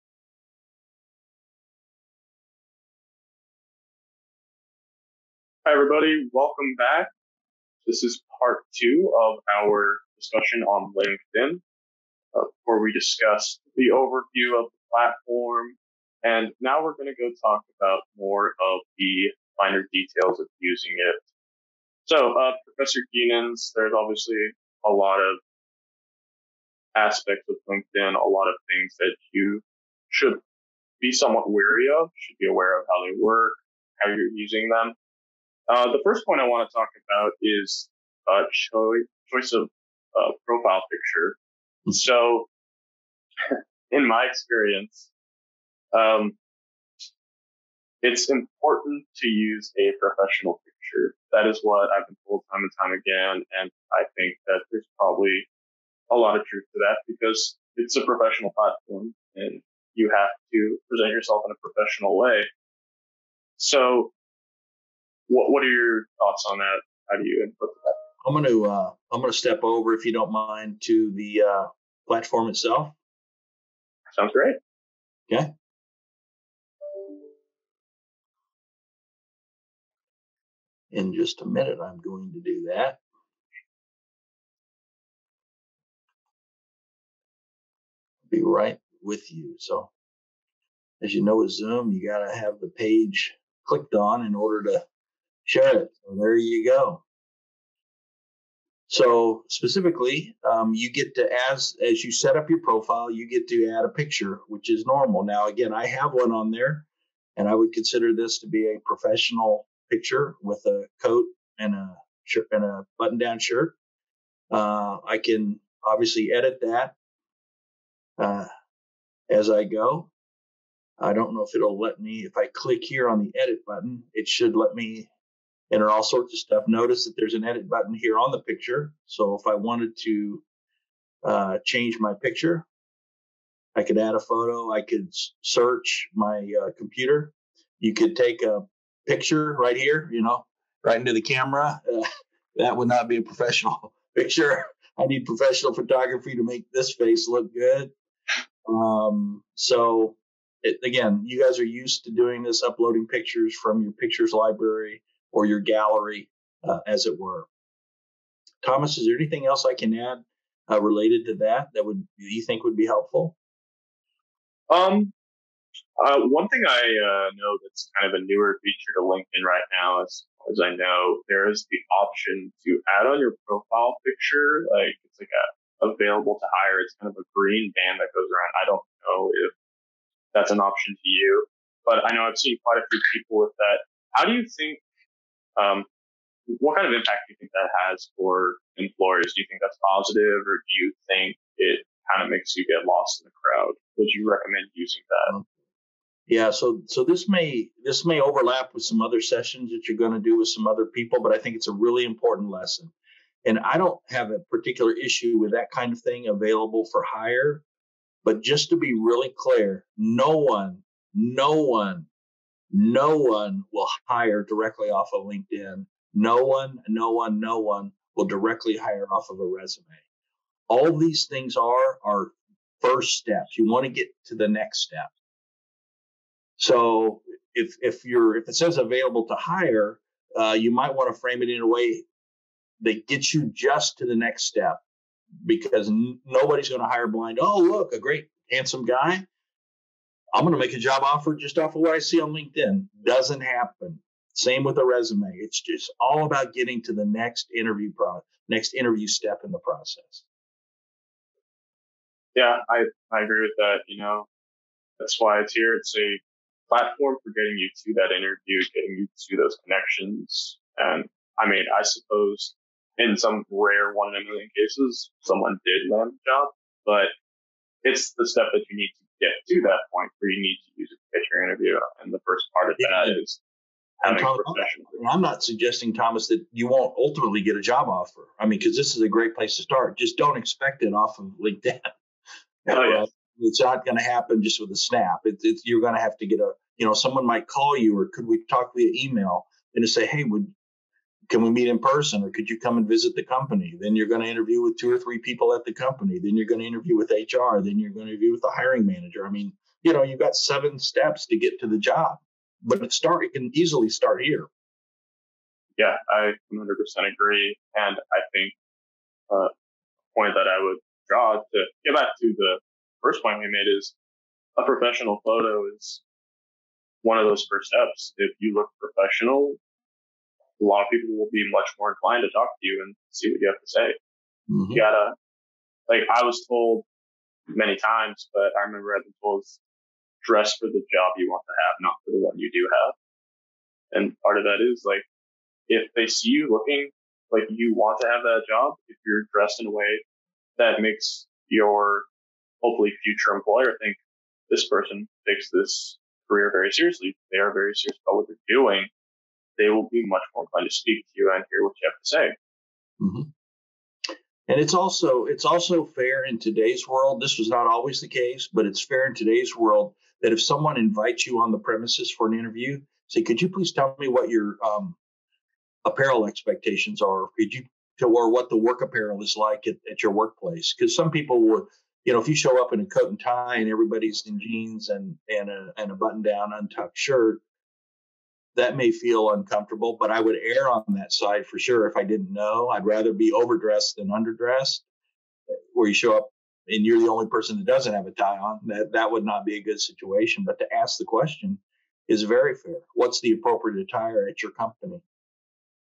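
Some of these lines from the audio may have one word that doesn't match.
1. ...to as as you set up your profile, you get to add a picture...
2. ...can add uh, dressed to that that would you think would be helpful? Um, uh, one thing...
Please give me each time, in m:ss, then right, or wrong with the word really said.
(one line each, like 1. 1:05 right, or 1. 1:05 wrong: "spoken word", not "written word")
1. 1:41 right
2. 2:39 wrong: "related", not "dressed".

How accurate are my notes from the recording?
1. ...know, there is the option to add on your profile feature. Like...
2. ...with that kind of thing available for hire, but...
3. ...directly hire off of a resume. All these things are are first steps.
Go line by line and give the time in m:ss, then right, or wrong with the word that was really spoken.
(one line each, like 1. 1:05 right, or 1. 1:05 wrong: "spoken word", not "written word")
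1. 2:50 wrong: "picture", not "feature"
2. 3:25 right
3. 3:38 right.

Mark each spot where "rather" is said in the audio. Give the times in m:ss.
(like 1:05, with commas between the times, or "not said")
6:22.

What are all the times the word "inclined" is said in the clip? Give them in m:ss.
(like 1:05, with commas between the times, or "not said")
5:21, 5:50.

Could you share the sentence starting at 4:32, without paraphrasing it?
And the first part of that yeah.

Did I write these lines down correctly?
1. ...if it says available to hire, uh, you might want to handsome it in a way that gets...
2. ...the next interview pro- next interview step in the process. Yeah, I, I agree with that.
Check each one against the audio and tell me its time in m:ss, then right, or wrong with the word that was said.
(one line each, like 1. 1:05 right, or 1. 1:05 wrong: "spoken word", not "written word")
1. 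3:48 wrong: "frame", not "handsome"
2. 4:06 right.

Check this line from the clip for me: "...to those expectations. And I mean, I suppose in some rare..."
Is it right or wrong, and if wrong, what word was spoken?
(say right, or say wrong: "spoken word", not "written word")
wrong: "connections", not "expectations".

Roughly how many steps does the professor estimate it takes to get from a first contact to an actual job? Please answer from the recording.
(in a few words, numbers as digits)
7.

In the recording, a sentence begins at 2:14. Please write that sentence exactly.
I could search my uh, computer.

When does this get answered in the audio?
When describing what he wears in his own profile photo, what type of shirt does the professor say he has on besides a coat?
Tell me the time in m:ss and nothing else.
1:52.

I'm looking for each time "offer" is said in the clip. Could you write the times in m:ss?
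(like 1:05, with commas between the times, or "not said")
4:01, 4:37.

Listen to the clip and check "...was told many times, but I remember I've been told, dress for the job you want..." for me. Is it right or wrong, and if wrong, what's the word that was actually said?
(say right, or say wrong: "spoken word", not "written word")
right.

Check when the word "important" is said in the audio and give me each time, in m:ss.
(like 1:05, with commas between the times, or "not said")
0:48, 3:22.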